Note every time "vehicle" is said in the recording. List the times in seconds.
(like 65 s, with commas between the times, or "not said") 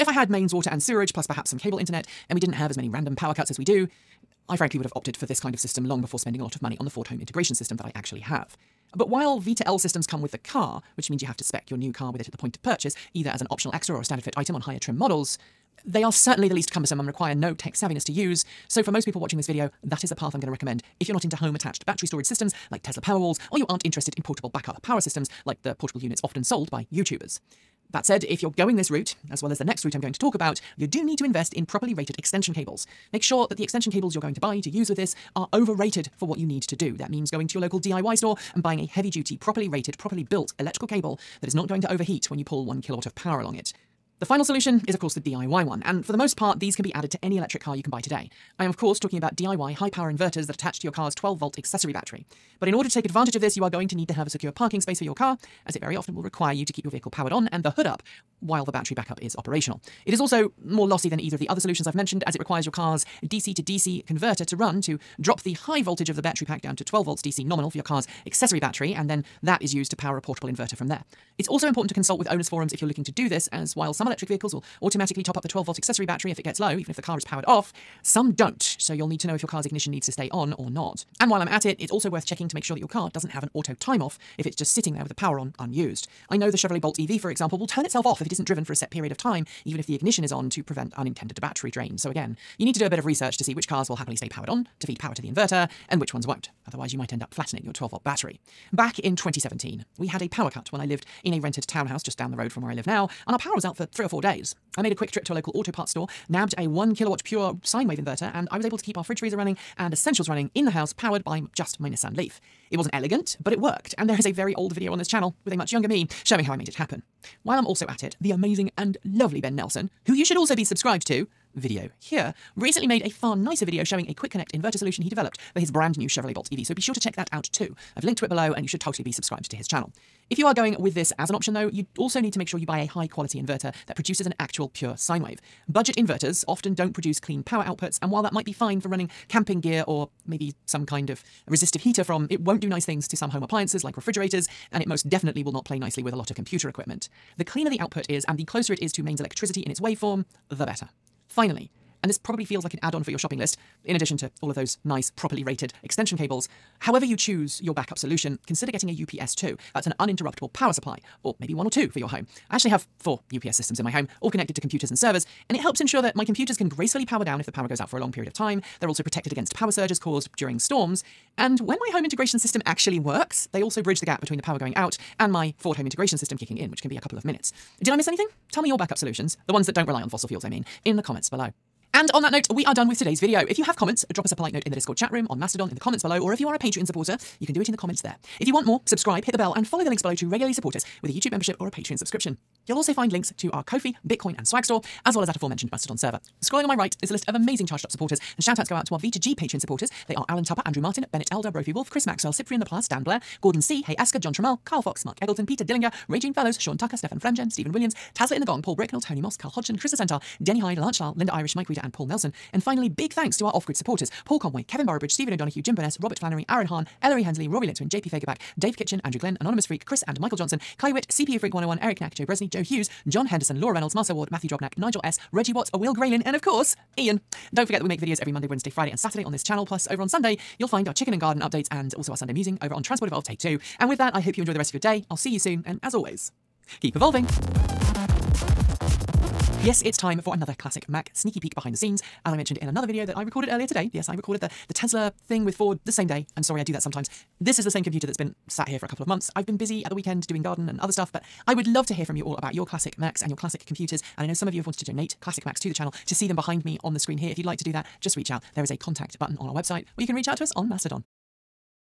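56 s, 74 s.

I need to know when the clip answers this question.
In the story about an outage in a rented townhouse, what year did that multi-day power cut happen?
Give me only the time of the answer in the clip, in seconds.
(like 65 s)
99 s.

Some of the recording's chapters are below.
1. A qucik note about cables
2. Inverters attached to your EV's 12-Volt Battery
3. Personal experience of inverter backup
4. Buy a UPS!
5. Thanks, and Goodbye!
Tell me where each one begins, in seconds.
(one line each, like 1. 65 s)
1. 27 s
2. 43 s
3. 98 s
4. 151 s
5. 181 s.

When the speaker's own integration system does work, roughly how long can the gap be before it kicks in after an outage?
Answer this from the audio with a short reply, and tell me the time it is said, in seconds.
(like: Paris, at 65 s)
a couple of minutes, at 176 s.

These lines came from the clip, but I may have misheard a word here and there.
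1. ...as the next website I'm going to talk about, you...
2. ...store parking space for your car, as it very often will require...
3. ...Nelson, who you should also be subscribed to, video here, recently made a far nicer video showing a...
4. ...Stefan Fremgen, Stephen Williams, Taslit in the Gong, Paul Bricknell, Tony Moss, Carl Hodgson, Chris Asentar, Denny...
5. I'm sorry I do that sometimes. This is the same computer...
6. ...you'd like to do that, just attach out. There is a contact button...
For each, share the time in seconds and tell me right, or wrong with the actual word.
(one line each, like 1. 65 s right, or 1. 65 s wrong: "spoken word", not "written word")
1. 29 s wrong: "route", not "website"
2. 54 s wrong: "secure", not "store"
3. 119 s right
4. 206 s right
5. 246 s right
6. 257 s wrong: "reach", not "attach".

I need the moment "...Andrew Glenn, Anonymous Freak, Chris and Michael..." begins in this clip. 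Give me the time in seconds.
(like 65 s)
219 s.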